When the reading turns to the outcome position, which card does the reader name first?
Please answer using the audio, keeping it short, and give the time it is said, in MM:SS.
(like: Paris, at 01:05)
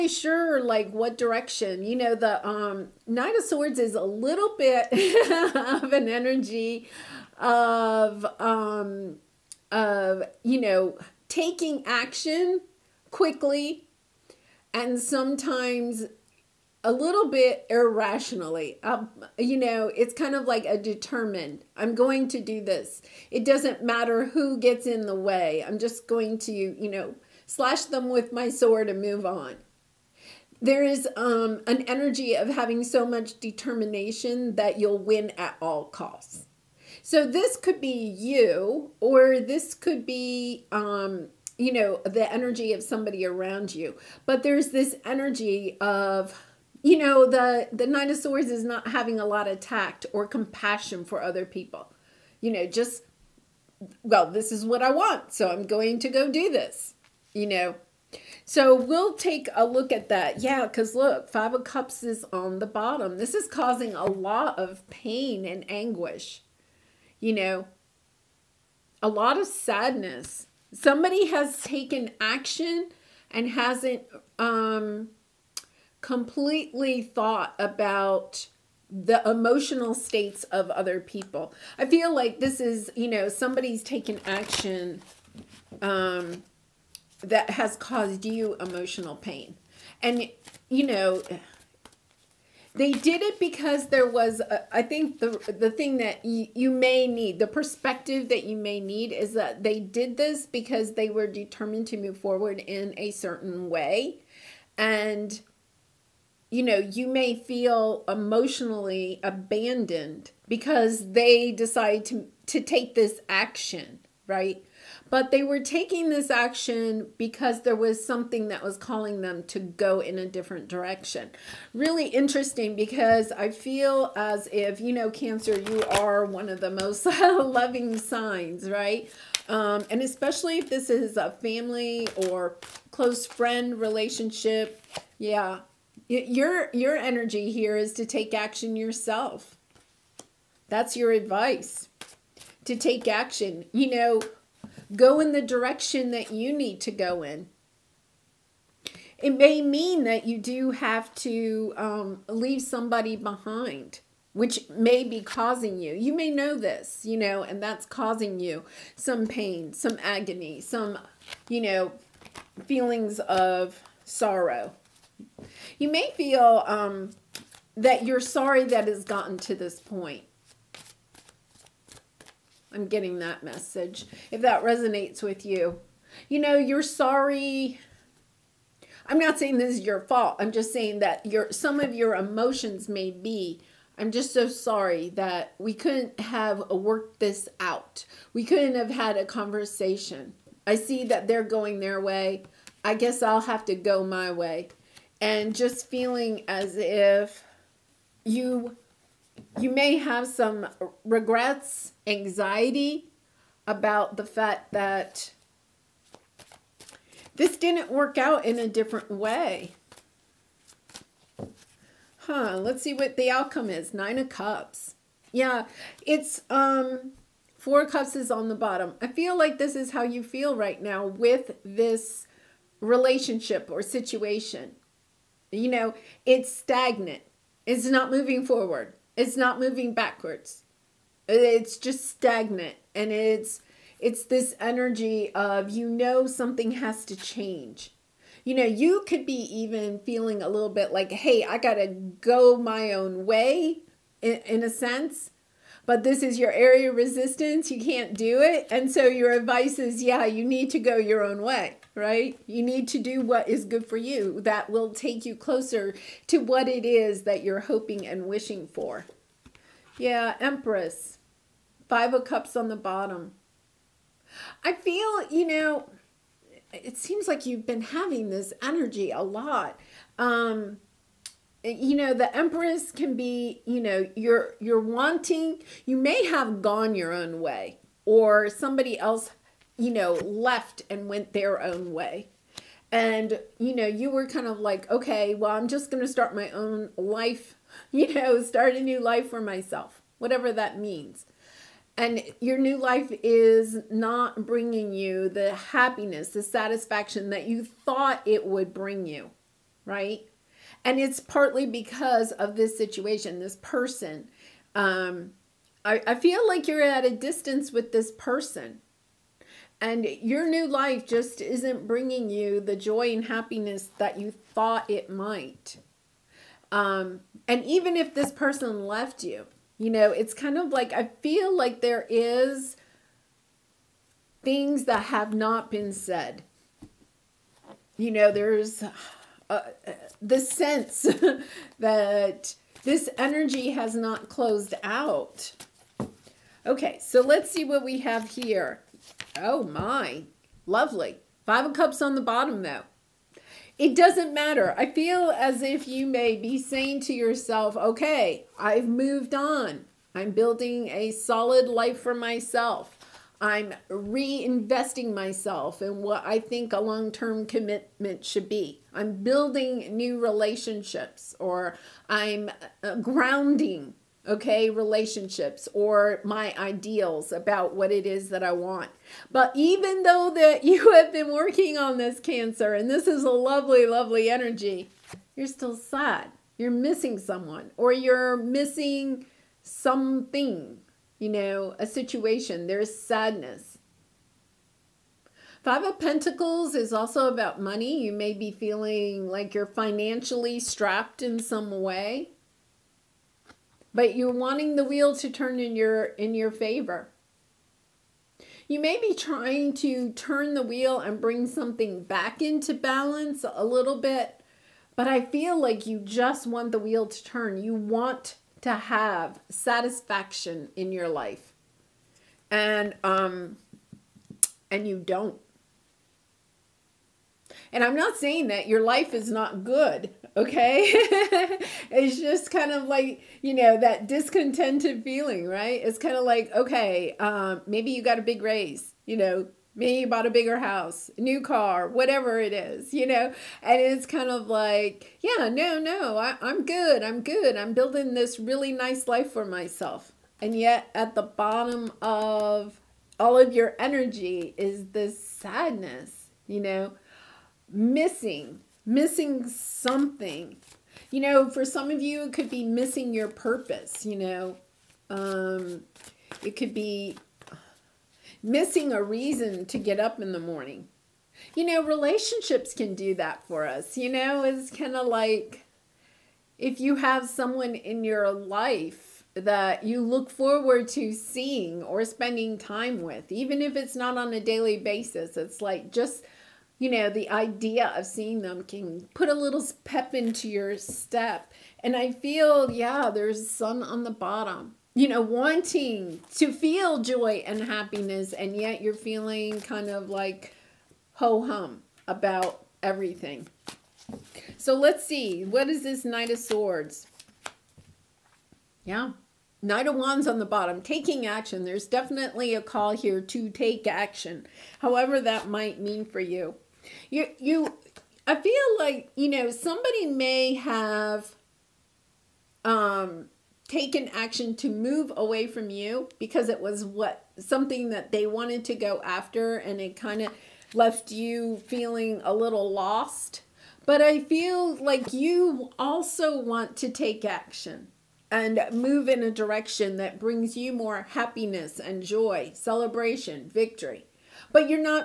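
Nine of Cups, at 03:33.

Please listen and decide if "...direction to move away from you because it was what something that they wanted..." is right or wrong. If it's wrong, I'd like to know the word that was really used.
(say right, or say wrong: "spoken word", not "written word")
wrong: "action", not "direction".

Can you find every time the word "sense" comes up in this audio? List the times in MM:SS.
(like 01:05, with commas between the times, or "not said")
04:04, 05:30.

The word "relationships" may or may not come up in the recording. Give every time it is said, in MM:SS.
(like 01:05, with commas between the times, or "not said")
02:13, 03:42, 06:00, 06:04, 07:41.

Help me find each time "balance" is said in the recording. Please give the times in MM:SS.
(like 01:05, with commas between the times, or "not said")
06:42.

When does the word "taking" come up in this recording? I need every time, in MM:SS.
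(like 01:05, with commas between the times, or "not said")
00:11, 01:55, 08:20.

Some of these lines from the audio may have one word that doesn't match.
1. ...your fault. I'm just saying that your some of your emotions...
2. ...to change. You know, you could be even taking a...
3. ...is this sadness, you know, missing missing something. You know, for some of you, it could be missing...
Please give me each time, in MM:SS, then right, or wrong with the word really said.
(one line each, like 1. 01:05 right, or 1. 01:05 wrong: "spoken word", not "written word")
1. 02:59 right
2. 03:57 wrong: "feeling", not "taking"
3. 07:24 right.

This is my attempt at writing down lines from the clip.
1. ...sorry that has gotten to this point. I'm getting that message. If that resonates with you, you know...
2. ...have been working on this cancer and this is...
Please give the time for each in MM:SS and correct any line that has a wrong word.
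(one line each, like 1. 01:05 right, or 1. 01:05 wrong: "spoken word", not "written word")
1. 02:48 right
2. 06:10 right.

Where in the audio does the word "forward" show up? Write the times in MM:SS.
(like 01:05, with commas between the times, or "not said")
01:42, 03:48, 07:50.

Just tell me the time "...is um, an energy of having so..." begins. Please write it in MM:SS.
00:30.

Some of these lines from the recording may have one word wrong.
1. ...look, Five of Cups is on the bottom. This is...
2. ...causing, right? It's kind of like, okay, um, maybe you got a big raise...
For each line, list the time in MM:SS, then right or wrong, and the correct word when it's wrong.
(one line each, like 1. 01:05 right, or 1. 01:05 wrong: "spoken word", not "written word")
1. 01:00 right
2. 07:05 wrong: "feeling", not "causing".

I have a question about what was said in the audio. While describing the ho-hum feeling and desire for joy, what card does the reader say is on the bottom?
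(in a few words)
Sun.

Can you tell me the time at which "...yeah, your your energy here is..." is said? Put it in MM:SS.
02:15.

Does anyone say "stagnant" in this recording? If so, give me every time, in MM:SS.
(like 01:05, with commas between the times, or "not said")
03:46, 03:52.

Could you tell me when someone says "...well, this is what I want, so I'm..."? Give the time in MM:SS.
00:54.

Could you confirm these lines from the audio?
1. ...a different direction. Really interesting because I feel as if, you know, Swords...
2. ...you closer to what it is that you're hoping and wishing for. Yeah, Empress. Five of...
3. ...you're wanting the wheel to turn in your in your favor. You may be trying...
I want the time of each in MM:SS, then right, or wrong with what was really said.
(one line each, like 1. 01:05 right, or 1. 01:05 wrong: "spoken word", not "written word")
1. 02:00 wrong: "Cancer", not "Swords"
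2. 04:15 right
3. 06:34 right.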